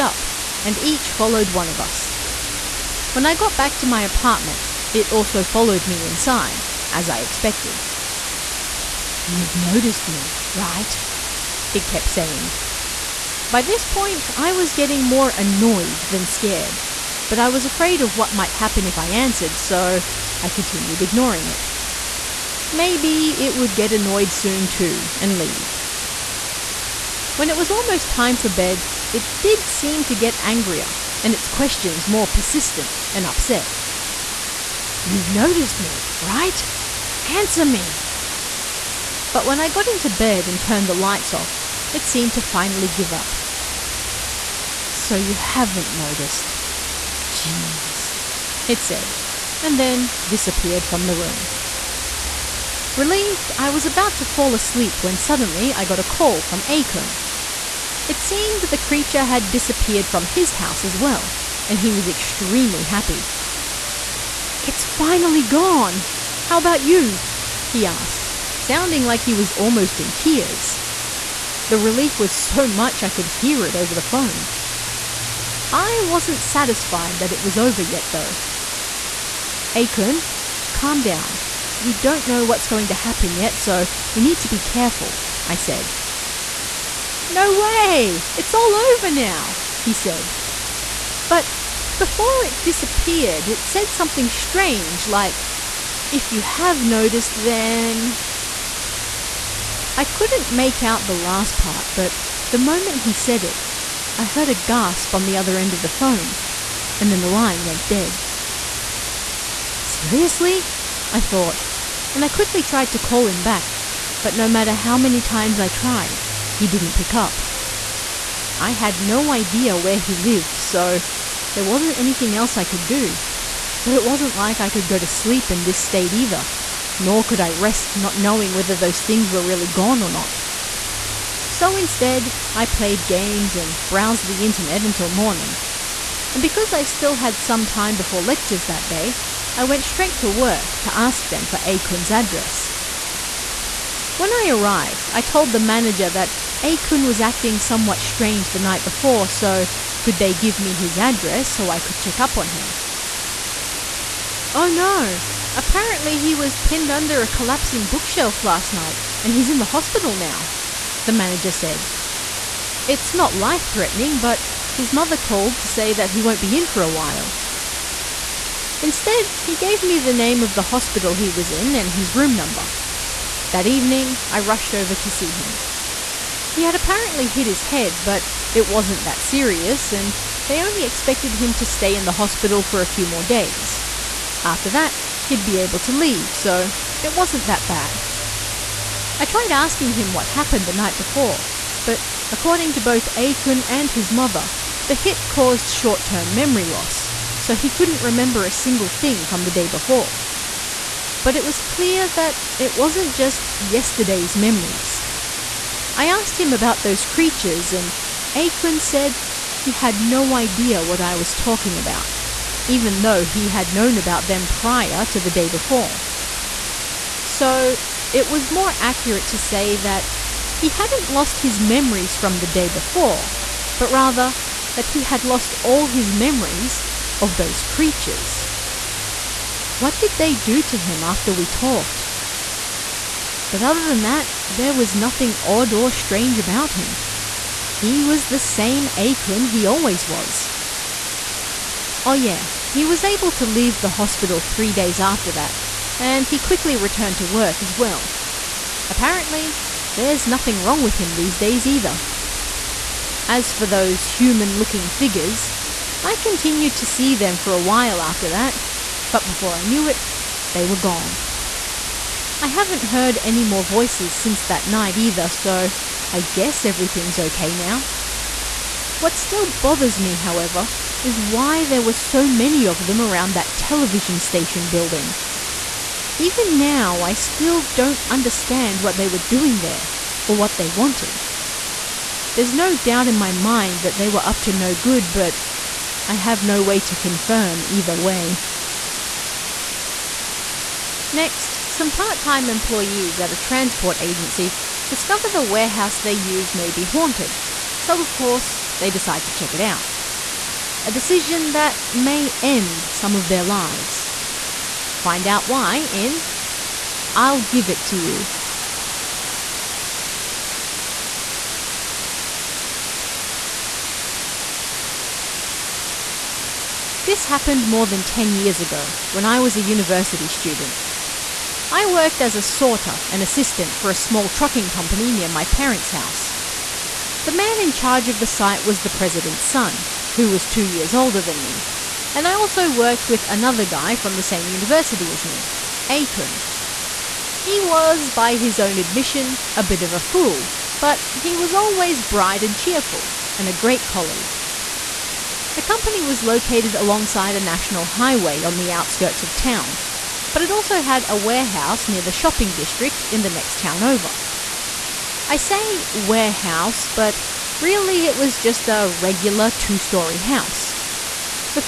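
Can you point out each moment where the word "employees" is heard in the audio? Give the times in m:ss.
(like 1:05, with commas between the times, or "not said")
4:52.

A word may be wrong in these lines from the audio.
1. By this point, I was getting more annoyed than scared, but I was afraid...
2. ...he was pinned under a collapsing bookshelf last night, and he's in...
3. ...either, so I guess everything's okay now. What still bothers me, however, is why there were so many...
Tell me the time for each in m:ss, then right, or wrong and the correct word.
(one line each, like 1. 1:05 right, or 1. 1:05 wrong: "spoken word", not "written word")
1. 0:13 right
2. 2:36 right
3. 4:24 right.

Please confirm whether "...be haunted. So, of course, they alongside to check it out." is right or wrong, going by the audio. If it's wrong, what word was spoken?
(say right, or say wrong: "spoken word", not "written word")
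wrong: "decide", not "alongside".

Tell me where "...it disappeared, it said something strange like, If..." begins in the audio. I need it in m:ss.
1:32.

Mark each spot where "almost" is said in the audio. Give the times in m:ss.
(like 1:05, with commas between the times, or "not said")
0:27, 1:09.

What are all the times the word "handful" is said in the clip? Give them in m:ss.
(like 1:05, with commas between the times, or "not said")
not said.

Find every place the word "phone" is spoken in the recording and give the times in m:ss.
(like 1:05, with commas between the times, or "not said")
1:14, 1:45.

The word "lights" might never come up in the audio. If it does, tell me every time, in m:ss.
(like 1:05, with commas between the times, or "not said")
0:40.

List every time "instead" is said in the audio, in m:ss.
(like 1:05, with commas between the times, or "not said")
2:11, 2:48.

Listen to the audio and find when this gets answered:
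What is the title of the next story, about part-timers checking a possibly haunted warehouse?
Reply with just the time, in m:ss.
5:07.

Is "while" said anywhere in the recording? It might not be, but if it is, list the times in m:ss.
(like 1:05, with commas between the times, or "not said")
2:46, 4:17.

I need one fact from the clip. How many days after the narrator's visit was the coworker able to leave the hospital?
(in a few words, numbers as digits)
3.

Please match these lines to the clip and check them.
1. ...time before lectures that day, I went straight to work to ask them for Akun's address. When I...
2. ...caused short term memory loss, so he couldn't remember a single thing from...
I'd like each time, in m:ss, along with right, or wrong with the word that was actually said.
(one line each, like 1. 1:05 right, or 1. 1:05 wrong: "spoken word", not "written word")
1. 2:17 right
2. 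3:15 right.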